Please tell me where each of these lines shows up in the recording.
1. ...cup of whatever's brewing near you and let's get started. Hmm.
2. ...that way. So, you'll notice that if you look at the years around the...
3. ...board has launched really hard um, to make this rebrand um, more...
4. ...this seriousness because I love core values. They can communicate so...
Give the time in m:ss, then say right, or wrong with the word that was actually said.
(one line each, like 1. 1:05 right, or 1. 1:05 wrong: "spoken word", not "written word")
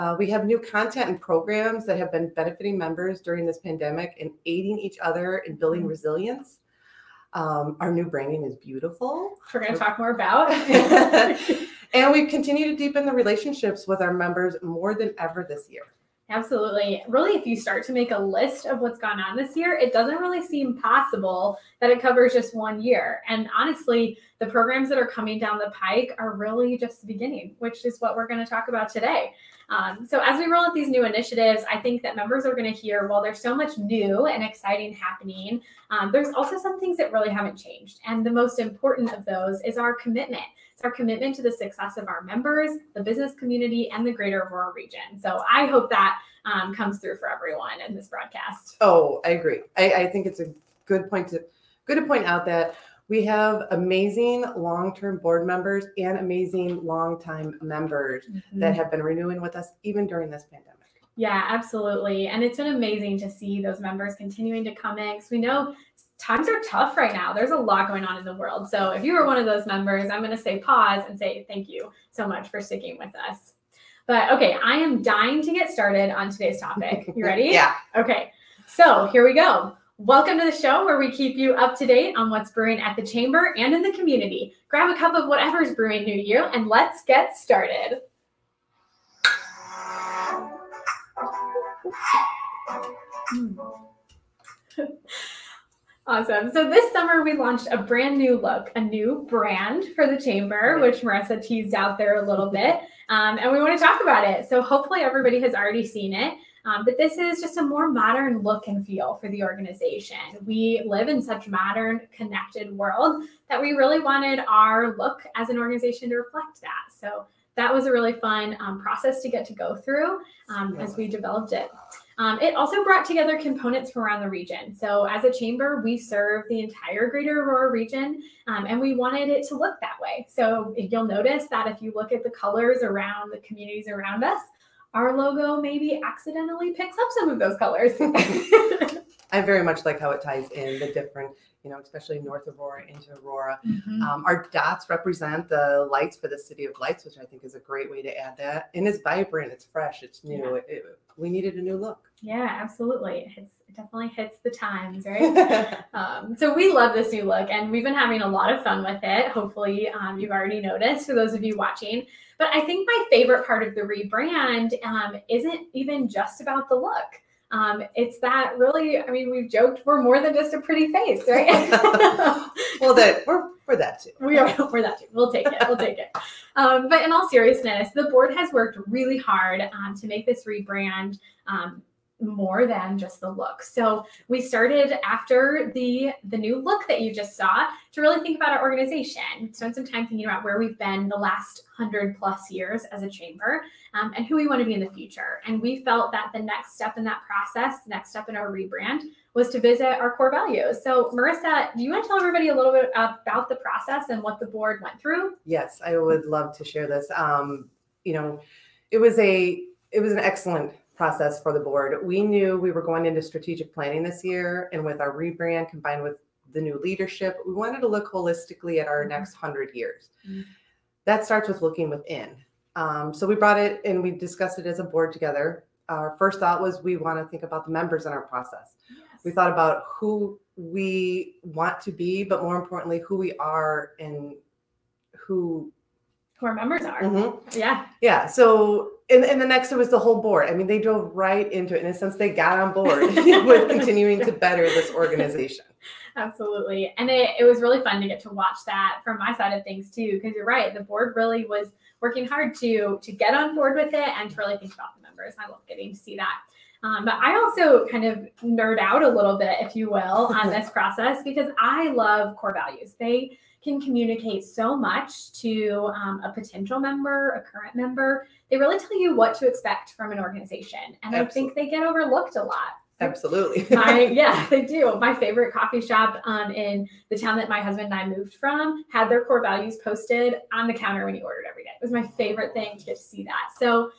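1. 1:24 right
2. 2:09 wrong: "colors", not "years"
3. 2:58 wrong: "worked", not "launched"
4. 4:20 wrong: "process", not "seriousness".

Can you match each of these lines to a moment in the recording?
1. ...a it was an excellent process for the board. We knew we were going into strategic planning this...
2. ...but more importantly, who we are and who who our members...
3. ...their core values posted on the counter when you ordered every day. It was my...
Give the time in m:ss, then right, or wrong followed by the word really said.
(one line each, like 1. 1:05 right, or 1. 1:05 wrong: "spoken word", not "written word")
1. 3:29 right
2. 3:52 right
3. 4:39 right.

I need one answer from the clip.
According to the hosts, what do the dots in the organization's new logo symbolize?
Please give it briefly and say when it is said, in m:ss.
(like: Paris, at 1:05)
Lights for the city of lights, at 2:26.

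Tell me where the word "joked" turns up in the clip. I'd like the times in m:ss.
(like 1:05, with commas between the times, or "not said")
2:49.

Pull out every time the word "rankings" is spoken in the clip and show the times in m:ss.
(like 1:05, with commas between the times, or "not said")
not said.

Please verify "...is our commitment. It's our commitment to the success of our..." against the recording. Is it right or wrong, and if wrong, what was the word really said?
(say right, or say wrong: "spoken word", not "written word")
right.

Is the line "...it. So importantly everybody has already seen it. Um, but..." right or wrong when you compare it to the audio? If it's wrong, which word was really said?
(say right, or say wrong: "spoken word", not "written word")
wrong: "hopefully", not "importantly".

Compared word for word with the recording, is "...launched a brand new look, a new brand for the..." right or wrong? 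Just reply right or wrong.
right.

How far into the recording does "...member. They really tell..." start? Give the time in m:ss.
4:27.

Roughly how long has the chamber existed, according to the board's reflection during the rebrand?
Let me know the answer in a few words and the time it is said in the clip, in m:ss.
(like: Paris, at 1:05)
Hundred plus years, at 3:11.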